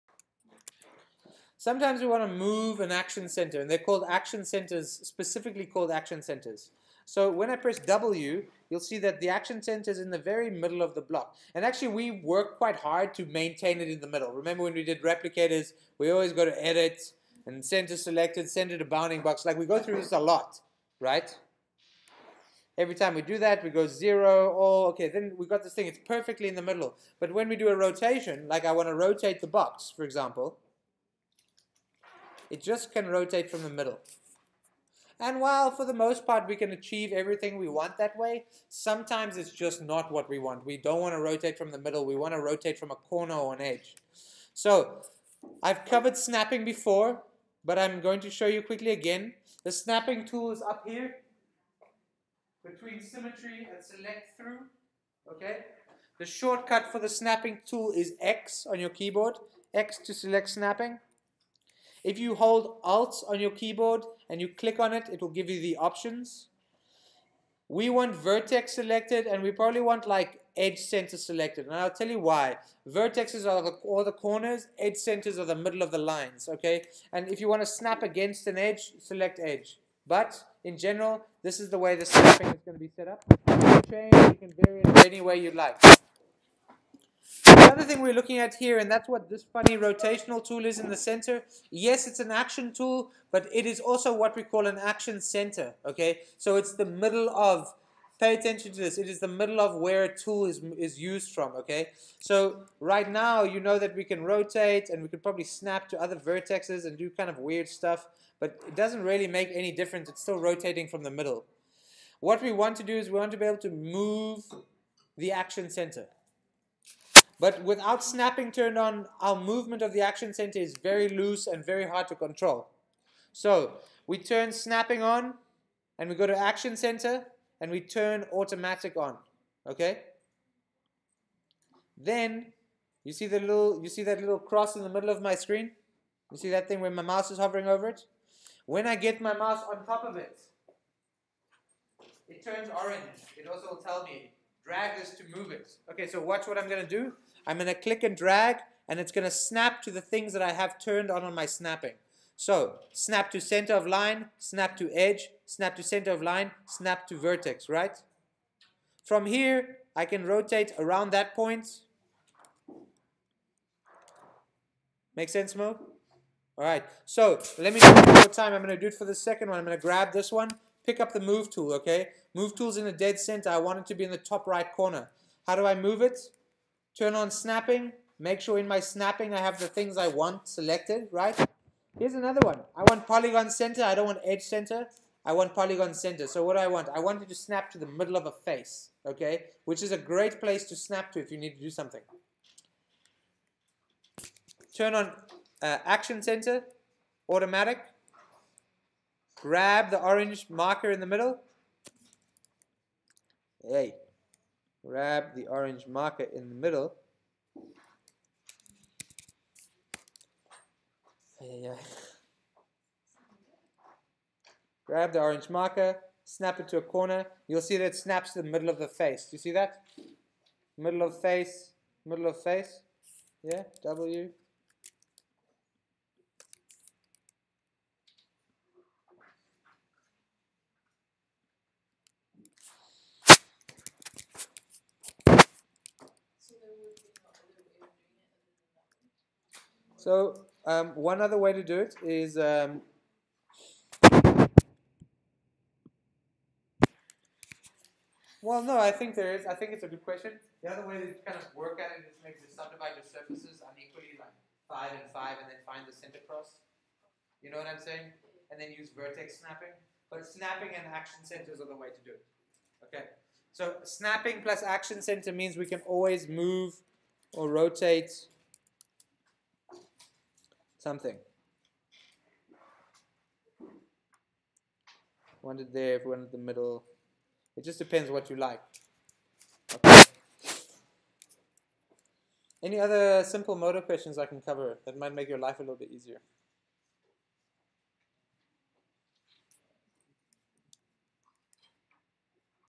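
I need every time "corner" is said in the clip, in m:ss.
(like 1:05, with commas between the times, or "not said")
0:42, 1:14, 2:54, 3:36.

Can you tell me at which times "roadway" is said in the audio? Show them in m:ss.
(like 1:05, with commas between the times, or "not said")
not said.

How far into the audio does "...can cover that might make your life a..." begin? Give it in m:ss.
4:44.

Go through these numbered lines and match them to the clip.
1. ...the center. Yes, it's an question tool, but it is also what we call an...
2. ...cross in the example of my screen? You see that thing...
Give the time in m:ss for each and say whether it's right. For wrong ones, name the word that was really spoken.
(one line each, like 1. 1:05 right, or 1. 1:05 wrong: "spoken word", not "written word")
1. 1:30 wrong: "action", not "question"
2. 2:14 wrong: "middle", not "example".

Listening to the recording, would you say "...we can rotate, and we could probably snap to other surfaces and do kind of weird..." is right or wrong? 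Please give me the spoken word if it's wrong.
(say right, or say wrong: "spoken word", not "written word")
wrong: "vertexes", not "surfaces".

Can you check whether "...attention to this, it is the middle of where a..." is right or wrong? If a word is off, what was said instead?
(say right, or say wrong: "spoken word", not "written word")
right.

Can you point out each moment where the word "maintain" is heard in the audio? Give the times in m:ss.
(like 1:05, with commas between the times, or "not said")
0:13.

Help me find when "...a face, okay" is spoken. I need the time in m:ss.
3:08.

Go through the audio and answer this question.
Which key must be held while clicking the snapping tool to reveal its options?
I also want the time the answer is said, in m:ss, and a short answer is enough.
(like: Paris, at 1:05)
Alt, at 1:02.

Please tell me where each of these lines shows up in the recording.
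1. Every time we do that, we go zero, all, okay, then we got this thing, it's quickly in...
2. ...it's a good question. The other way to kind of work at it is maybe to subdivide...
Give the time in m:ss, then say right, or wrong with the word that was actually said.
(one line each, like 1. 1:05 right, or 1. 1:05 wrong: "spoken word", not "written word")
1. 0:22 wrong: "perfectly", not "quickly"
2. 4:09 right.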